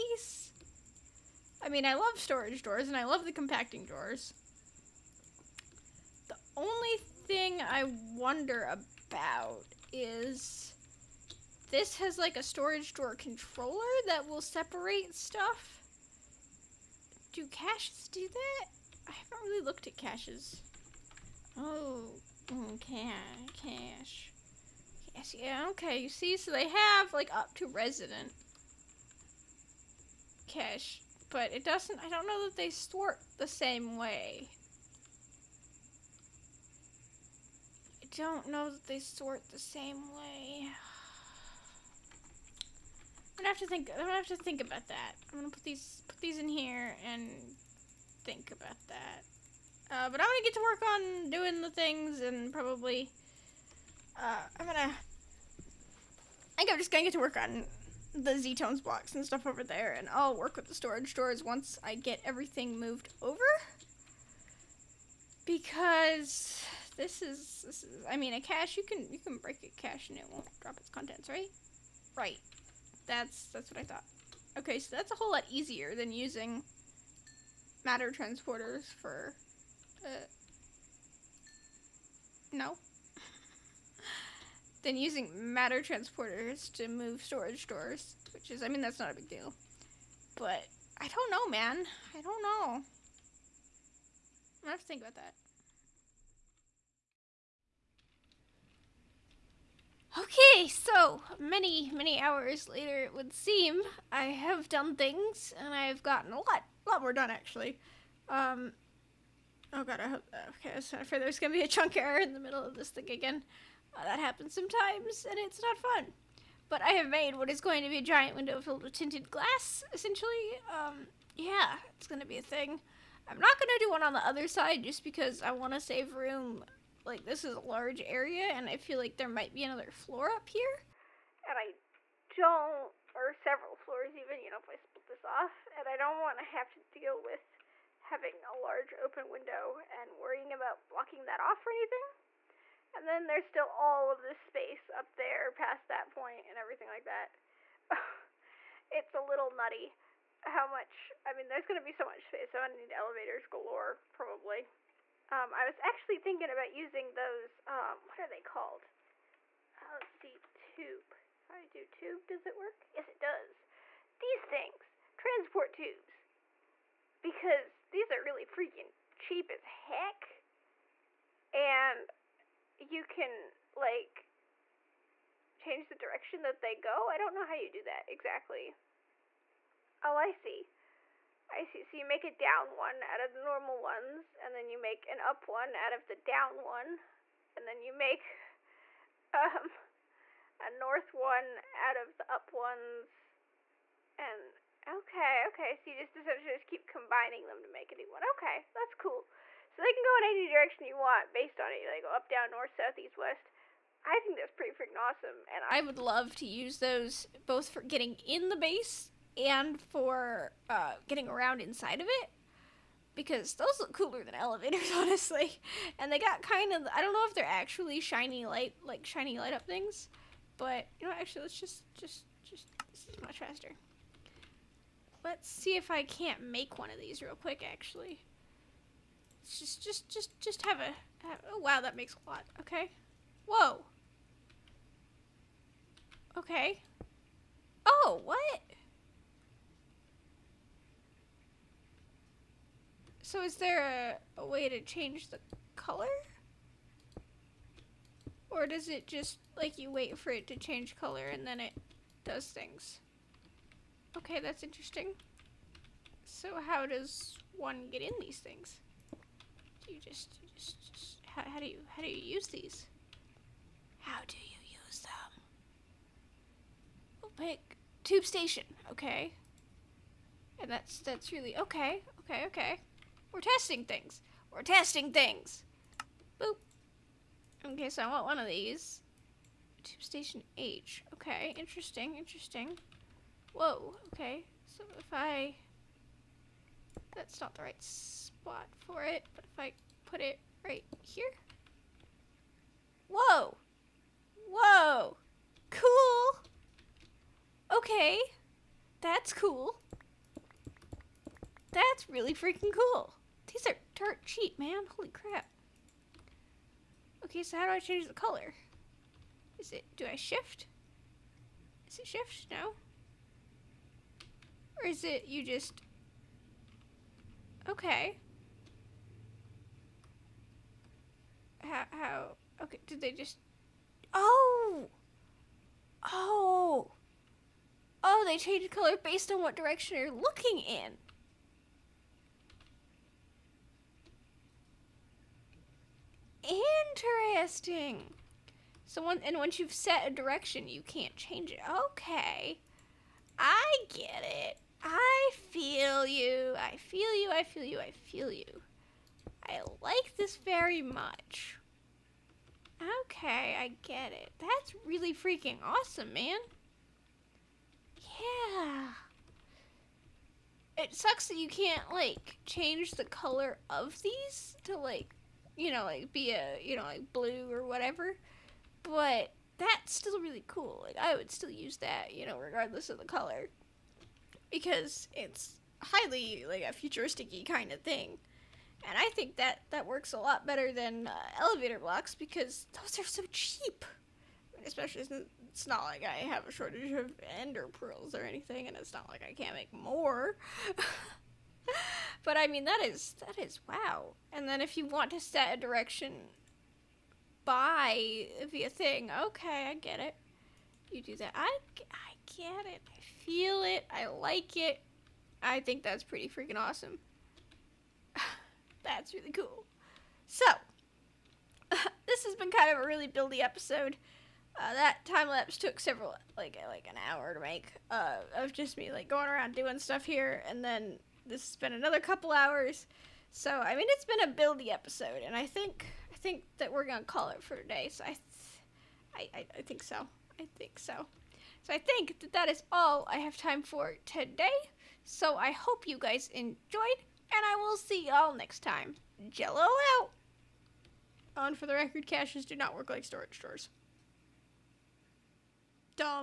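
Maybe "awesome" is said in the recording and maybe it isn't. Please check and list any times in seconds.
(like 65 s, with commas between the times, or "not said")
204 s, 355 s, 406 s.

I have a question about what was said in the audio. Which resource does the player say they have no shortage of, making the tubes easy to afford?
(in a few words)
Ender pearls.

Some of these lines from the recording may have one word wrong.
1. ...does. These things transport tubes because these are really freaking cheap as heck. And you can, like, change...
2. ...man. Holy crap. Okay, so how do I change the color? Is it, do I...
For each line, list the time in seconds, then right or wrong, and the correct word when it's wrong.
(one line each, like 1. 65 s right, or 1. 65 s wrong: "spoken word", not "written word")
1. 163 s right
2. 304 s right.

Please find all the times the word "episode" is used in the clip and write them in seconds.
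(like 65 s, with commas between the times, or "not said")
413 s, 424 s.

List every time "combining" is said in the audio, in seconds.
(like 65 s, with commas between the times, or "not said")
196 s.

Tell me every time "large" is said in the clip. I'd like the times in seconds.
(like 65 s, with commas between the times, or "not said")
127 s, 138 s.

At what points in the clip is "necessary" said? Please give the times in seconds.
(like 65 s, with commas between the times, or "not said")
not said.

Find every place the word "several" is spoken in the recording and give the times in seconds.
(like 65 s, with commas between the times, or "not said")
133 s, 415 s.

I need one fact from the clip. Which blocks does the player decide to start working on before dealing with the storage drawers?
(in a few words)
Z-Tones blocks.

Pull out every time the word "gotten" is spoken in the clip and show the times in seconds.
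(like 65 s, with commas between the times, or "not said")
106 s.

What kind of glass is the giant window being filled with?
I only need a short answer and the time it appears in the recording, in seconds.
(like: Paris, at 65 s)
Tinted glass, at 118 s.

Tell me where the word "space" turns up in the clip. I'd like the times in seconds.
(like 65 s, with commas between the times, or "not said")
144 s, 152 s.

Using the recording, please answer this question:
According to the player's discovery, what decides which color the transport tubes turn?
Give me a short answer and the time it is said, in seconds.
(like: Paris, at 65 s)
Direction you're looking, at 329 s.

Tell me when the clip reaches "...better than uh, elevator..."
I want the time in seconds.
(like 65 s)
380 s.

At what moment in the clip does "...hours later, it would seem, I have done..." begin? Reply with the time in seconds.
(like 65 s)
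102 s.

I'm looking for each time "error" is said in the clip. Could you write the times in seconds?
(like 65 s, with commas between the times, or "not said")
111 s.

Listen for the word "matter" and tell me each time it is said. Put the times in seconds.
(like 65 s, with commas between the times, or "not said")
77 s, 85 s.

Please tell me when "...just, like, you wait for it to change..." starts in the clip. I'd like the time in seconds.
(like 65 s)
249 s.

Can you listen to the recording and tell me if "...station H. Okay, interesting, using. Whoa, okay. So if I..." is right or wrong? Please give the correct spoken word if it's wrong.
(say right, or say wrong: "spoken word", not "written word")
wrong: "interesting", not "using".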